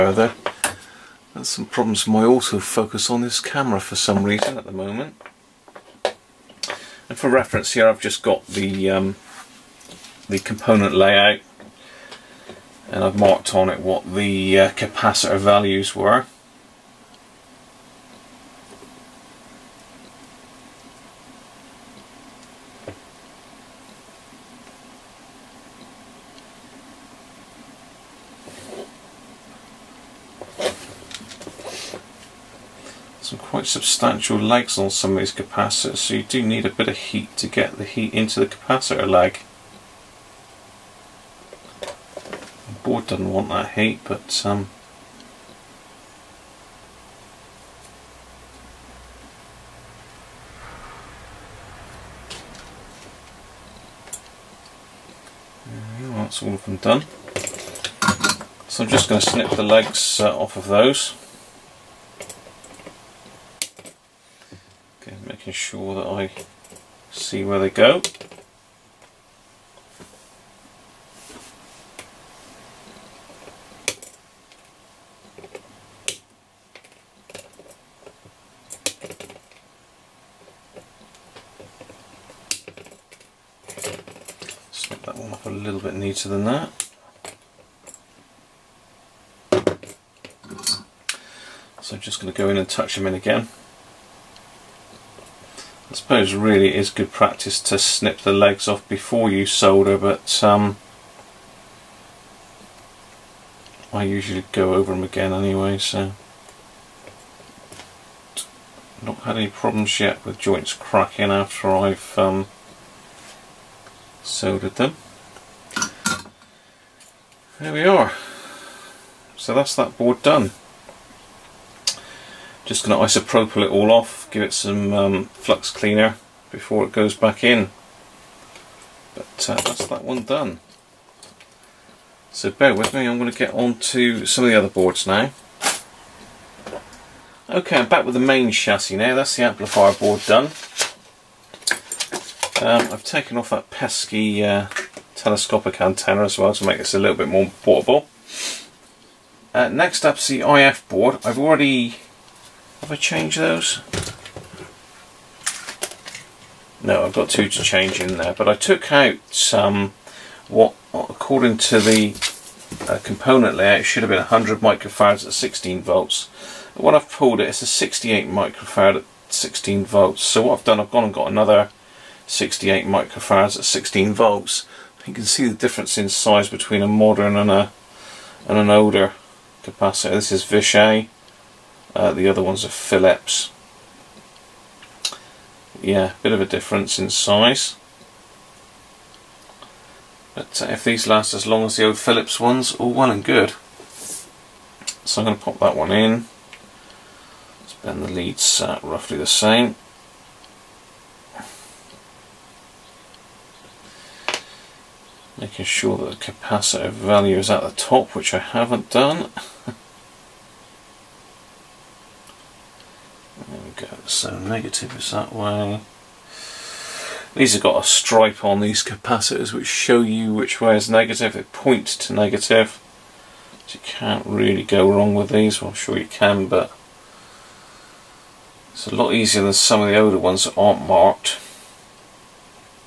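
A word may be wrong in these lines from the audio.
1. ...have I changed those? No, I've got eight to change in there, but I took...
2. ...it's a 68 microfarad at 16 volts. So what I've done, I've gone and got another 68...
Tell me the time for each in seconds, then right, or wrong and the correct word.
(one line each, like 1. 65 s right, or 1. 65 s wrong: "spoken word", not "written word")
1. 152 s wrong: "two", not "eight"
2. 167 s right.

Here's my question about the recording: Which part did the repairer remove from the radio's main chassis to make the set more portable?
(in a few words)
telescopic antenna.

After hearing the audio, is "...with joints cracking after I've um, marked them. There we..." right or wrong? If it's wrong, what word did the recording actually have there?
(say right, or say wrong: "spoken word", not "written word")
wrong: "soldered", not "marked".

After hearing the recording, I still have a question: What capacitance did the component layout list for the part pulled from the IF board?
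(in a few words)
100 microfarads.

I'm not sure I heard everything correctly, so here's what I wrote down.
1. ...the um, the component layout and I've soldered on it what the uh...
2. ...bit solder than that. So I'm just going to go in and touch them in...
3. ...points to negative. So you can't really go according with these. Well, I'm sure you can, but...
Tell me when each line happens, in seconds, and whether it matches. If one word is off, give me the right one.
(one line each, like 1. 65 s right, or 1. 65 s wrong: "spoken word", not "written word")
1. 8 s wrong: "marked", not "soldered"
2. 85 s wrong: "neater", not "solder"
3. 221 s wrong: "wrong", not "according".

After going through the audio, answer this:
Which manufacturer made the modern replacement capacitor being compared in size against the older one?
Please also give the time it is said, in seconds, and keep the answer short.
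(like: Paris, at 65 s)
Vishay, at 180 s.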